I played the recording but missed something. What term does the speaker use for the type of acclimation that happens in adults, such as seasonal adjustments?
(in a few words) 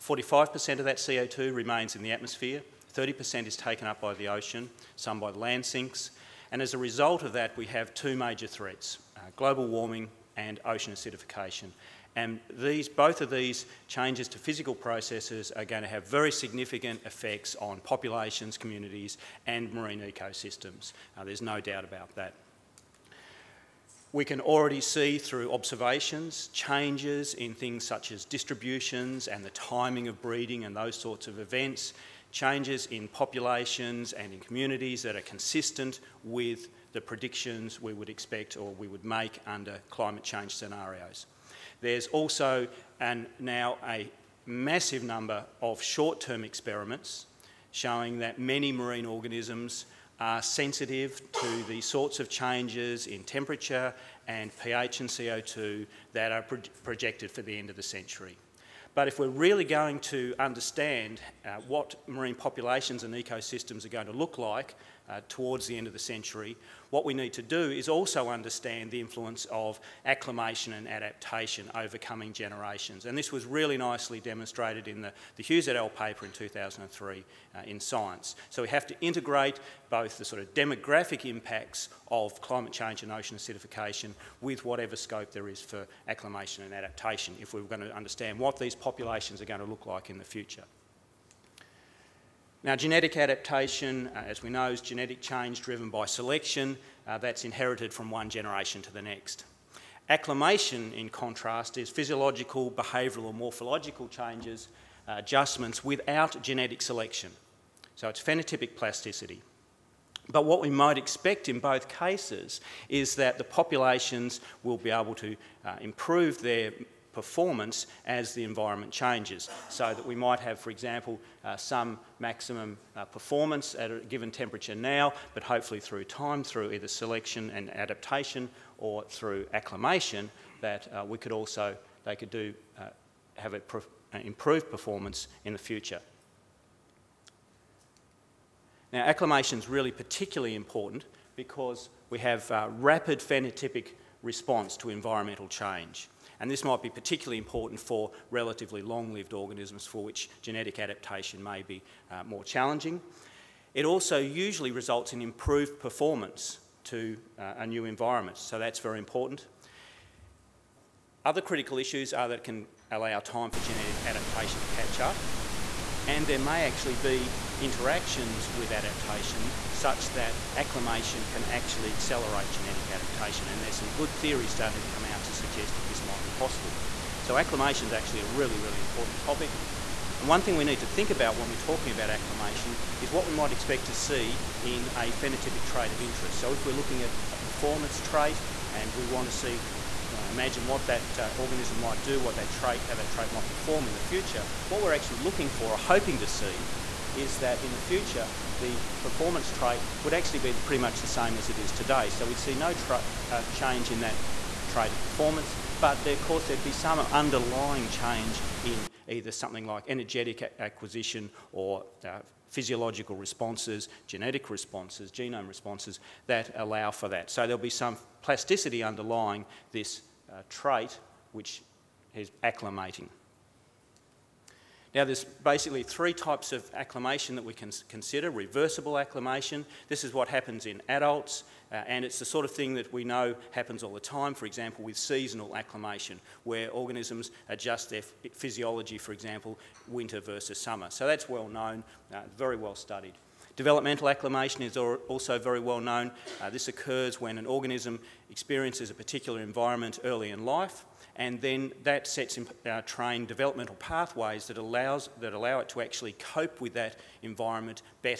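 Reversible acclimation.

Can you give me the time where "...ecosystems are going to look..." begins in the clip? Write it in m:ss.
1:03.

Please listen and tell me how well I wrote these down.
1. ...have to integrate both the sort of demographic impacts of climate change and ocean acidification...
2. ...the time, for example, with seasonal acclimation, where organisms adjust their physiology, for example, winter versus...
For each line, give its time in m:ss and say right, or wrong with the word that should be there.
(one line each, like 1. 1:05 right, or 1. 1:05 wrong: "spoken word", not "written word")
1. 1:18 right
2. 3:53 right.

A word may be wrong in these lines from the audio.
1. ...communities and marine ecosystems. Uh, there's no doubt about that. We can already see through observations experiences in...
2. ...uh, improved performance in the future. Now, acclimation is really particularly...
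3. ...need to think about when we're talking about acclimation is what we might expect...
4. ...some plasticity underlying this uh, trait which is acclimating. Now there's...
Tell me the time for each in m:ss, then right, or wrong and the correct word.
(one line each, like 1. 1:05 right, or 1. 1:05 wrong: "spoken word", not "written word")
1. 0:18 wrong: "changes", not "experiences"
2. 2:13 right
3. 3:00 right
4. 3:37 right.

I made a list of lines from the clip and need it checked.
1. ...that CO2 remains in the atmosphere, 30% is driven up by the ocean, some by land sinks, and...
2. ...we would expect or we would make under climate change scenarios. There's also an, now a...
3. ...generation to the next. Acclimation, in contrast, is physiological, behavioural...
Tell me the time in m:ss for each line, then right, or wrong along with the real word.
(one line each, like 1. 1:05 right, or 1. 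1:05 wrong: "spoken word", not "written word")
1. 0:00 wrong: "taken", not "driven"
2. 0:37 right
3. 1:38 right.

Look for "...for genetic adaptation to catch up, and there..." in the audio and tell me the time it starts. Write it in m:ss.
2:43.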